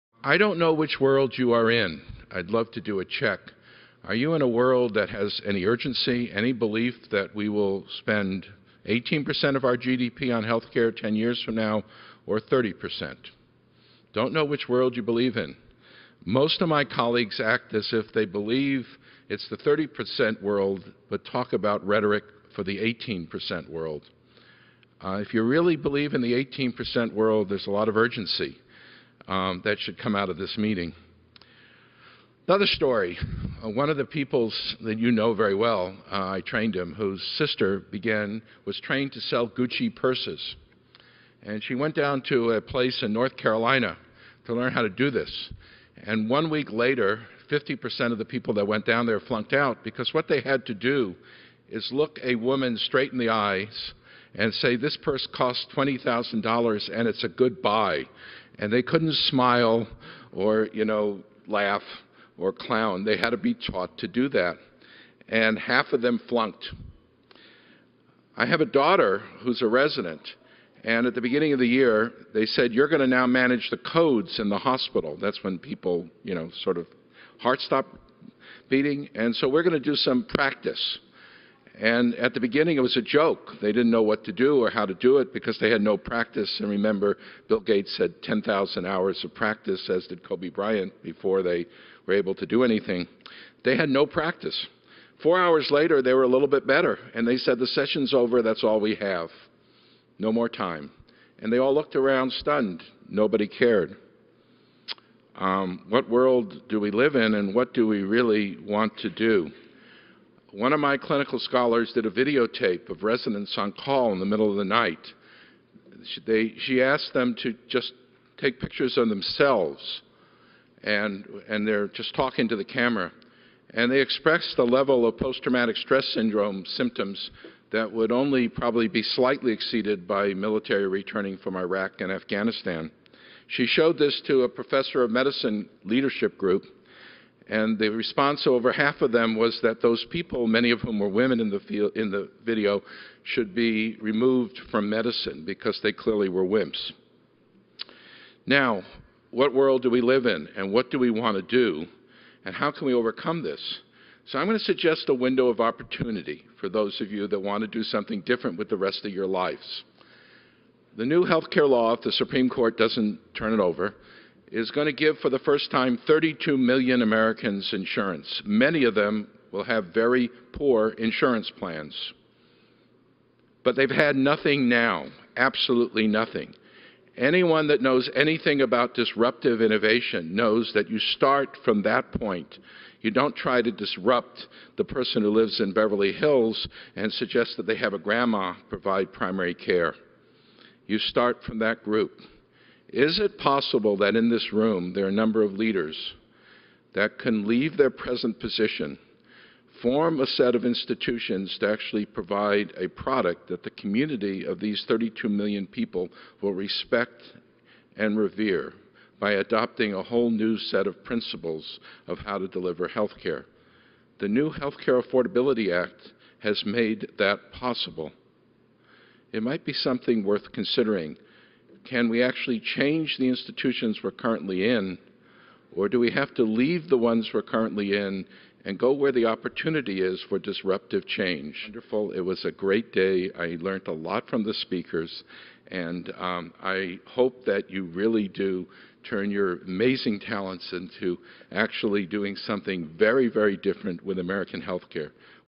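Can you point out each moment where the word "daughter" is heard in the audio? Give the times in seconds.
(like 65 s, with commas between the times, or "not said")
68 s.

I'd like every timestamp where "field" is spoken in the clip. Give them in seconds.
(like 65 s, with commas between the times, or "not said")
141 s.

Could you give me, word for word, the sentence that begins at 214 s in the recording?
The new Health Care Affordability Act has made that possible.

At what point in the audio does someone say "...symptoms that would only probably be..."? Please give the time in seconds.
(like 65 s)
126 s.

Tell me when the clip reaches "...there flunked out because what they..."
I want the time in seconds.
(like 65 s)
49 s.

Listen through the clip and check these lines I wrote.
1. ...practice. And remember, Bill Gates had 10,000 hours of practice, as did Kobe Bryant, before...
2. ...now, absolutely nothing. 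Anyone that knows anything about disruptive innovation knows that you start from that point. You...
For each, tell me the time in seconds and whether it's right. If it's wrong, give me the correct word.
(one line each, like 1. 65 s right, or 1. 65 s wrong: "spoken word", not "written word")
1. 85 s right
2. 174 s right.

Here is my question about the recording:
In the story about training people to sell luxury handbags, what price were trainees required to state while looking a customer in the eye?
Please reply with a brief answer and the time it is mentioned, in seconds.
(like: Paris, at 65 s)
$20,000, at 55 s.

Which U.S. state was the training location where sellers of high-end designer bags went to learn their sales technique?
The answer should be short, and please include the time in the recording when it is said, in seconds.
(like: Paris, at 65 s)
North Carolina, at 43 s.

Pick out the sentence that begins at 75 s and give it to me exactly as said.
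That's when people, you know, sort of heart stop beating.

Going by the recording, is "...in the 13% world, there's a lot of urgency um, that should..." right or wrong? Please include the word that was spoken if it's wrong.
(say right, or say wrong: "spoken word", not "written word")
wrong: "18", not "13".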